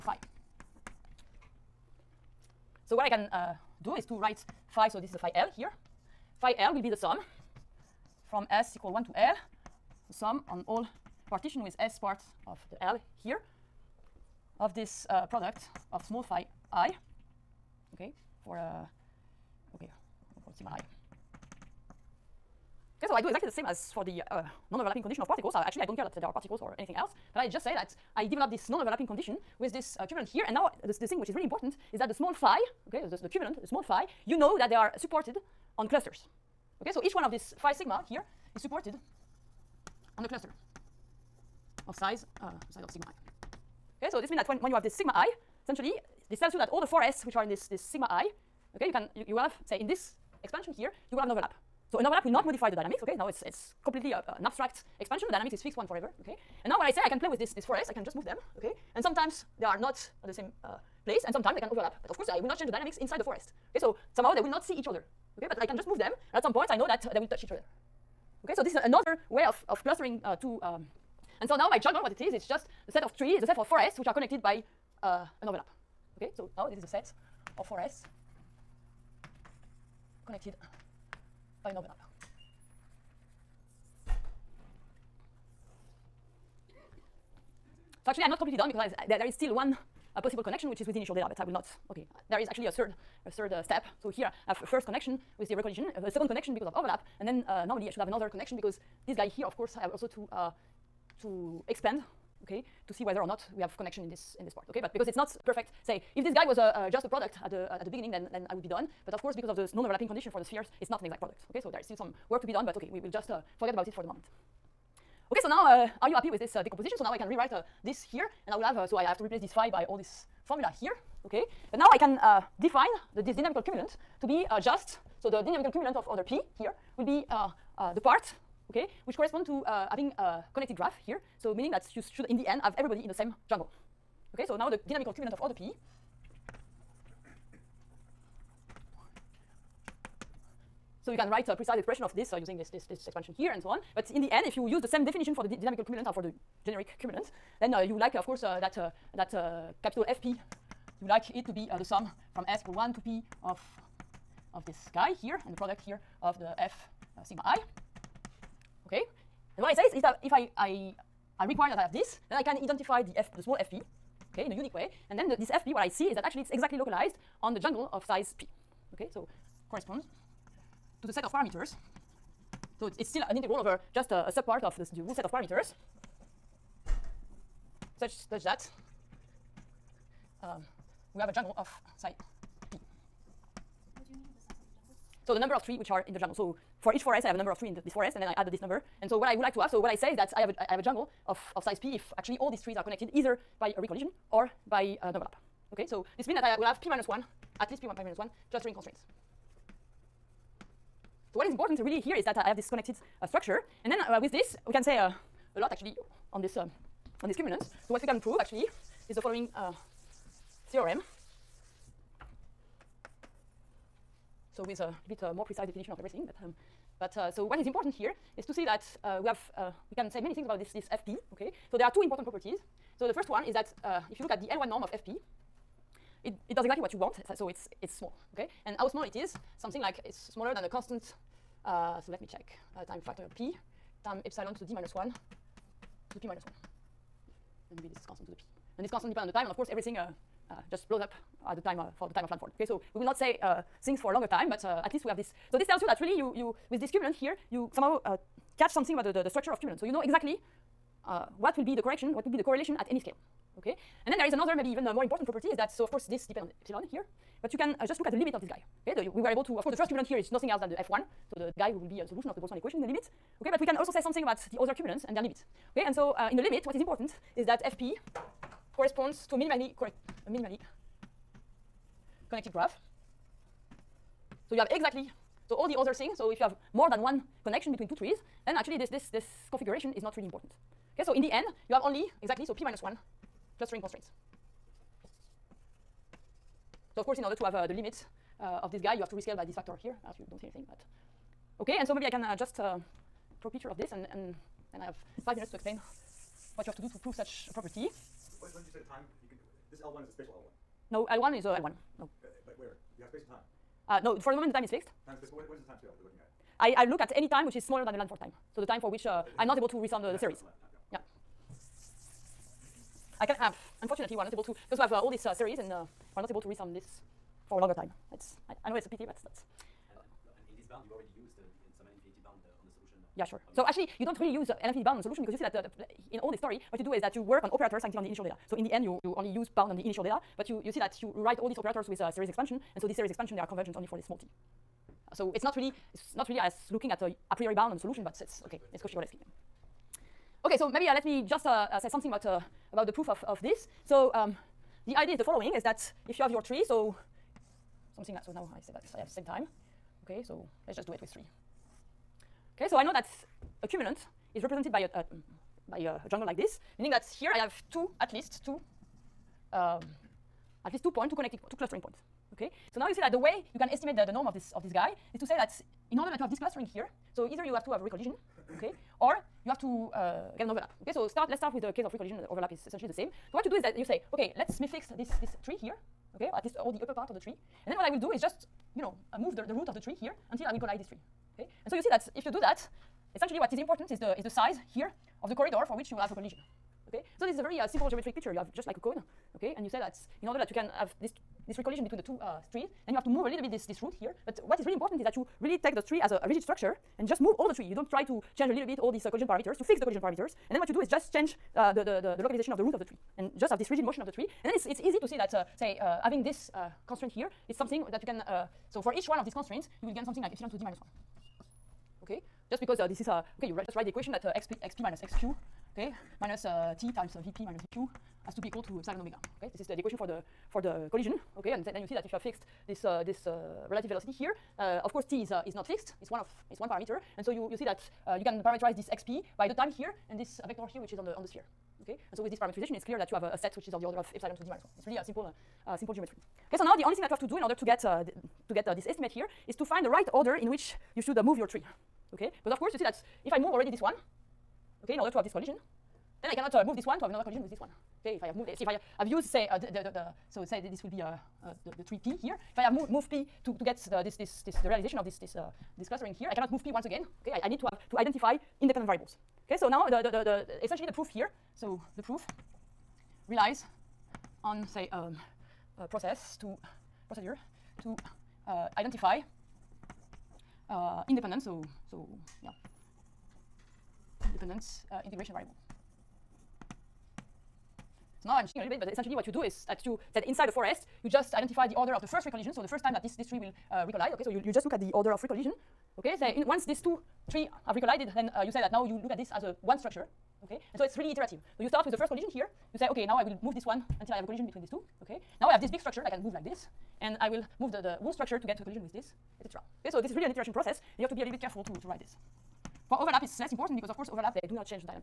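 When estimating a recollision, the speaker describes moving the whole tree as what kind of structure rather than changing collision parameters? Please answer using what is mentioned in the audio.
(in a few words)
Rigid structure.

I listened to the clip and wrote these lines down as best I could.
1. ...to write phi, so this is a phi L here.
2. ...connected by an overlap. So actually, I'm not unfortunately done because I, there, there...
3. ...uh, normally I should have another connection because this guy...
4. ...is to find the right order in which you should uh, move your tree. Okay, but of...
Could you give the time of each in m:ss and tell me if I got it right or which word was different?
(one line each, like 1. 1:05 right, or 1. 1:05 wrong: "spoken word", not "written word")
1. 0:04 right
2. 1:20 wrong: "completely", not "unfortunately"
3. 1:37 right
4. 7:19 right.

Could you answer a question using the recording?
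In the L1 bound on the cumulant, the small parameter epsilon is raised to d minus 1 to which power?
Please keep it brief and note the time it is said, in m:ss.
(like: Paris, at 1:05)
p minus 1, at 3:56.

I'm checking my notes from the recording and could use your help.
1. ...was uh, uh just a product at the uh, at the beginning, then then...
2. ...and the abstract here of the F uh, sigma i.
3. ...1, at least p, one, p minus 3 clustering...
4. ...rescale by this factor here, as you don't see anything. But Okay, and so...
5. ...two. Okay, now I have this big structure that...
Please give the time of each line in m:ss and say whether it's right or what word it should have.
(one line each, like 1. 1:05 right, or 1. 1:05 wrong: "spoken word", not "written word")
1. 1:46 right
2. 2:35 wrong: "product", not "abstract"
3. 3:17 wrong: "1", not "3"
4. 4:49 right
5. 8:14 right.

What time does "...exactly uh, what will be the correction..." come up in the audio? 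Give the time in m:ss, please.
4:10.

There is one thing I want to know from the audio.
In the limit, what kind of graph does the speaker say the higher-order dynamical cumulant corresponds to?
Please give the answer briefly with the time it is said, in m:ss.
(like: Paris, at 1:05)
Minimally connected graph, at 4:30.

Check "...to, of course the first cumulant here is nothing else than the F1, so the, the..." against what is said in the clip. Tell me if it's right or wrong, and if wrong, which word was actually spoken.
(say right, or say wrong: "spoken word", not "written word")
right.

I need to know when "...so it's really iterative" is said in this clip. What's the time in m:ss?
8:10.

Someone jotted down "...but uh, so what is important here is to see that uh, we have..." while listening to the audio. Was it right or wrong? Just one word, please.
right.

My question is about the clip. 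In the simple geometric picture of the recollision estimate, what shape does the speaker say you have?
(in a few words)
A cone.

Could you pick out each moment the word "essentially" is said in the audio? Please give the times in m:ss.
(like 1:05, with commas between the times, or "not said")
0:45, 6:12, 6:23, 7:40, 7:58.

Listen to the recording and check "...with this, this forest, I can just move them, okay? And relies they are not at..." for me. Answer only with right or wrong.
wrong.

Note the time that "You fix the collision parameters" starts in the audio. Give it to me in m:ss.
6:39.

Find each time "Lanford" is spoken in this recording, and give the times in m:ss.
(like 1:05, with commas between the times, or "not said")
4:02, 5:07.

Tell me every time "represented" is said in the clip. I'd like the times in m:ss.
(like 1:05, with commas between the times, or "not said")
5:54.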